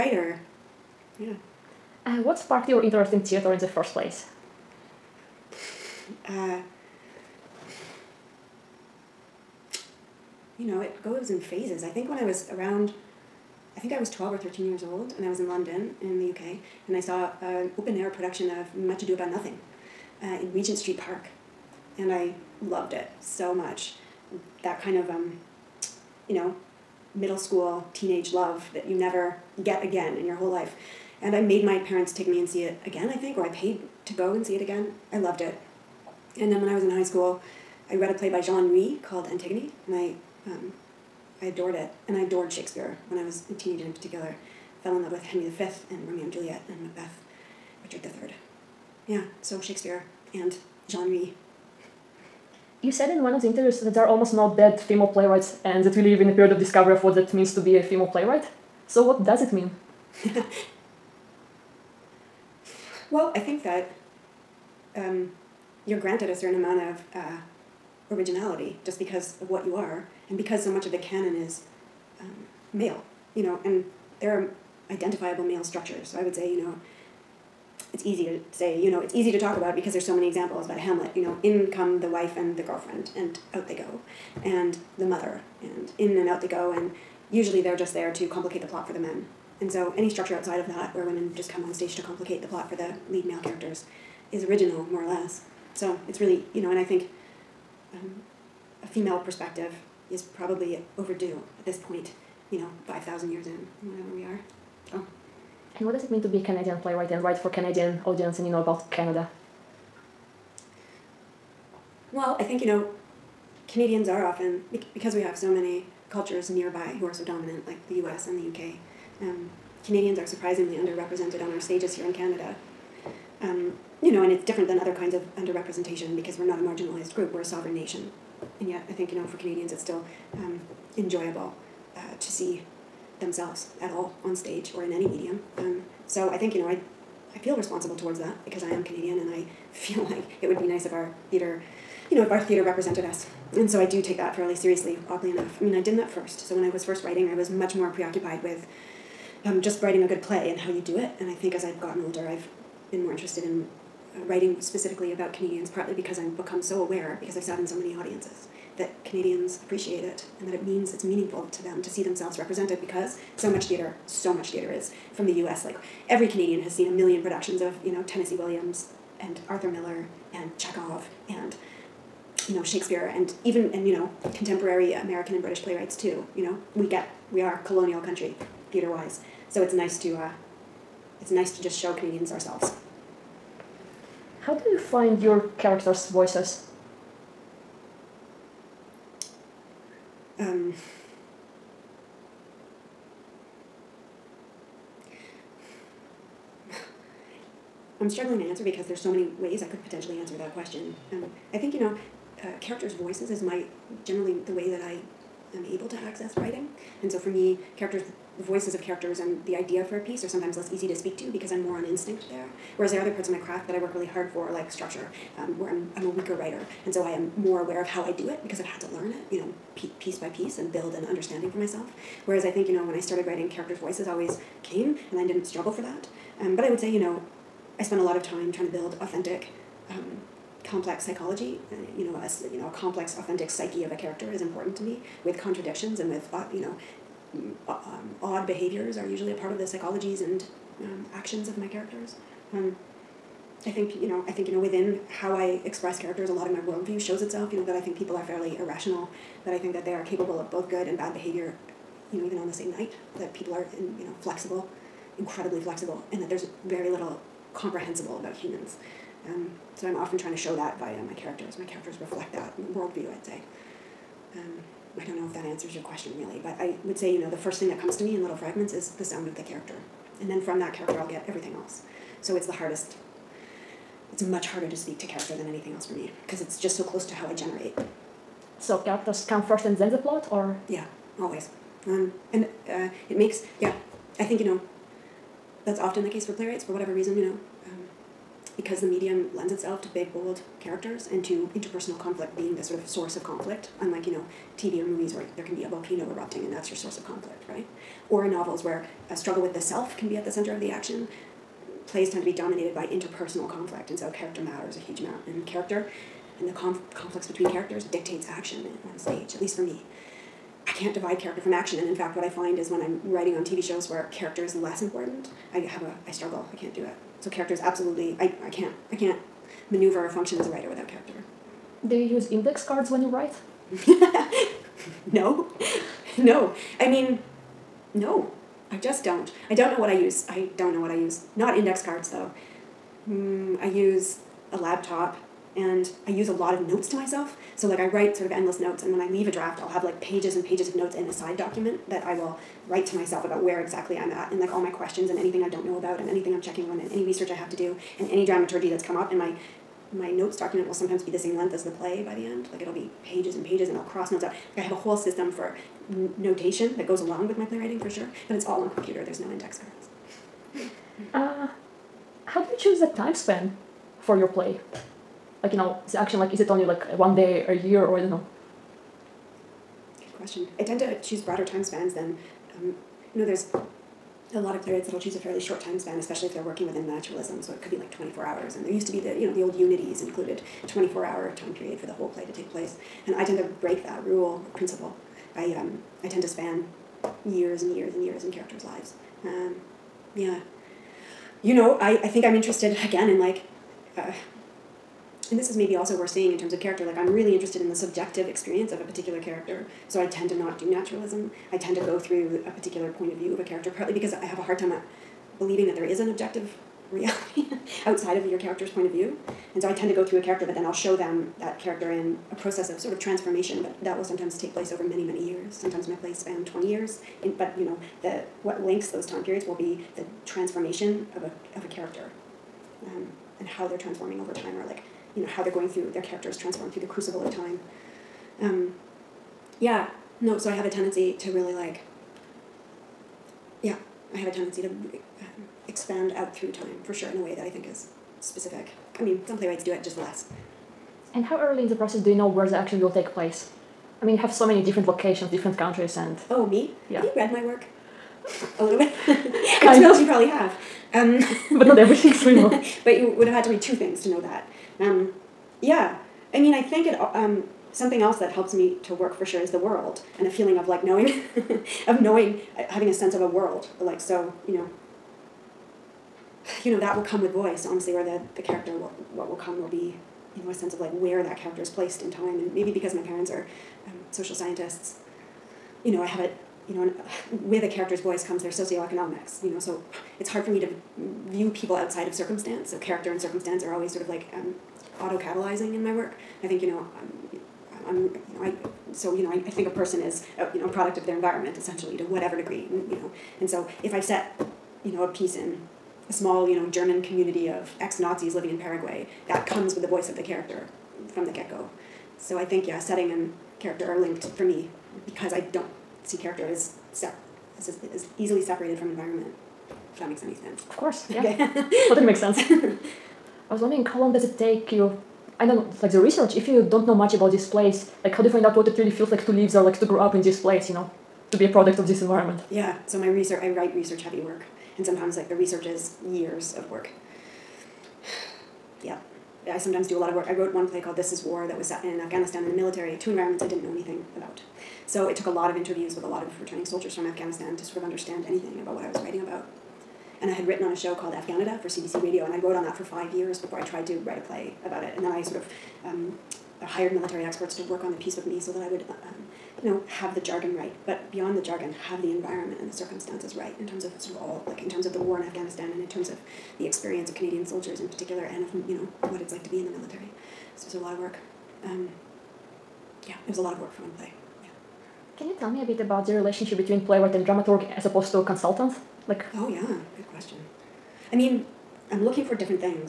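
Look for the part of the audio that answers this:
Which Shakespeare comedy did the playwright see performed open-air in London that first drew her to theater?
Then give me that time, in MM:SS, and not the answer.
00:18.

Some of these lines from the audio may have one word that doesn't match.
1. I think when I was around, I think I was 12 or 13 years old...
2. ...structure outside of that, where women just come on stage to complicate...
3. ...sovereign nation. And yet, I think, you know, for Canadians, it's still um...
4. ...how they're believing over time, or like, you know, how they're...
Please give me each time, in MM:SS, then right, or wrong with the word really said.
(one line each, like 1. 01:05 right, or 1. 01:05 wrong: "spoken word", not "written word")
1. 00:11 right
2. 01:30 right
3. 02:07 right
4. 07:03 wrong: "transforming", not "believing".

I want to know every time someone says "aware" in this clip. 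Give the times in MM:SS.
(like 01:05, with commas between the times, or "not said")
02:36, 03:37.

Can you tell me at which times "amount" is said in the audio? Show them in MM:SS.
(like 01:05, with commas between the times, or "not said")
01:06, 05:04.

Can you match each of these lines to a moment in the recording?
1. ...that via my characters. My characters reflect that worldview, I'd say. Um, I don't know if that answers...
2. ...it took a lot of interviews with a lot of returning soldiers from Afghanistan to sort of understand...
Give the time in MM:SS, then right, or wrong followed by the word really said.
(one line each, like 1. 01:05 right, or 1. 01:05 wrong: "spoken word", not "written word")
1. 04:20 right
2. 08:55 right.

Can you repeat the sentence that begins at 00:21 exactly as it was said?
And I loved it so much.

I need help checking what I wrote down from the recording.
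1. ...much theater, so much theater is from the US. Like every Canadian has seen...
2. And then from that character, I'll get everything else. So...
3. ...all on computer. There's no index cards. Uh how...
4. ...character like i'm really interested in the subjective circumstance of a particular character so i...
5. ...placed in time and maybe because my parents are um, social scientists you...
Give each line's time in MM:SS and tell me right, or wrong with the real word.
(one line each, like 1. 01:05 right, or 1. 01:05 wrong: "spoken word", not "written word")
1. 02:43 right
2. 04:30 right
3. 05:58 right
4. 06:36 wrong: "experience", not "circumstance"
5. 07:51 right.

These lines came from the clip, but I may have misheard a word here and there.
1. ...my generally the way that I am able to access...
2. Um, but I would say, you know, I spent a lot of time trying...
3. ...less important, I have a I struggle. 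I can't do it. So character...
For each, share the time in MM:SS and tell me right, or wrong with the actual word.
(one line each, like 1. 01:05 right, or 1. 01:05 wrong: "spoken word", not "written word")
1. 03:23 right
2. 03:46 right
3. 05:14 right.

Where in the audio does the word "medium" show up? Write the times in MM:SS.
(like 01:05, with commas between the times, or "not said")
02:15, 04:48.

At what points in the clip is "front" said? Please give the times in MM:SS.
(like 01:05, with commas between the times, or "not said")
not said.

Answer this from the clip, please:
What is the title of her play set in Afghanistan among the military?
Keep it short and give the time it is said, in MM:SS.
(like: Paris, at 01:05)
This Is War, at 08:50.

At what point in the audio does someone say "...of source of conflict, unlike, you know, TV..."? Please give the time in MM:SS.
04:52.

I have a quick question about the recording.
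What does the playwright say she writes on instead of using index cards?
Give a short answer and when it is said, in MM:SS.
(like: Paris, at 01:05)
A laptop, at 05:34.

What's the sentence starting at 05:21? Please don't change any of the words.
Do you use index cards when you write?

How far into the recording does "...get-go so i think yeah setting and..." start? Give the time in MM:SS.
08:21.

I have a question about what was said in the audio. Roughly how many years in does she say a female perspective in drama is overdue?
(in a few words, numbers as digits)
5,000.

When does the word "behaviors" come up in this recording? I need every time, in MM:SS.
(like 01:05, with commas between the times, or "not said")
03:58, 04:11.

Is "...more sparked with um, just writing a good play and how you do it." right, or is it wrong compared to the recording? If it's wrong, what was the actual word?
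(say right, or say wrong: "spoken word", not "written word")
wrong: "preoccupied", not "sparked".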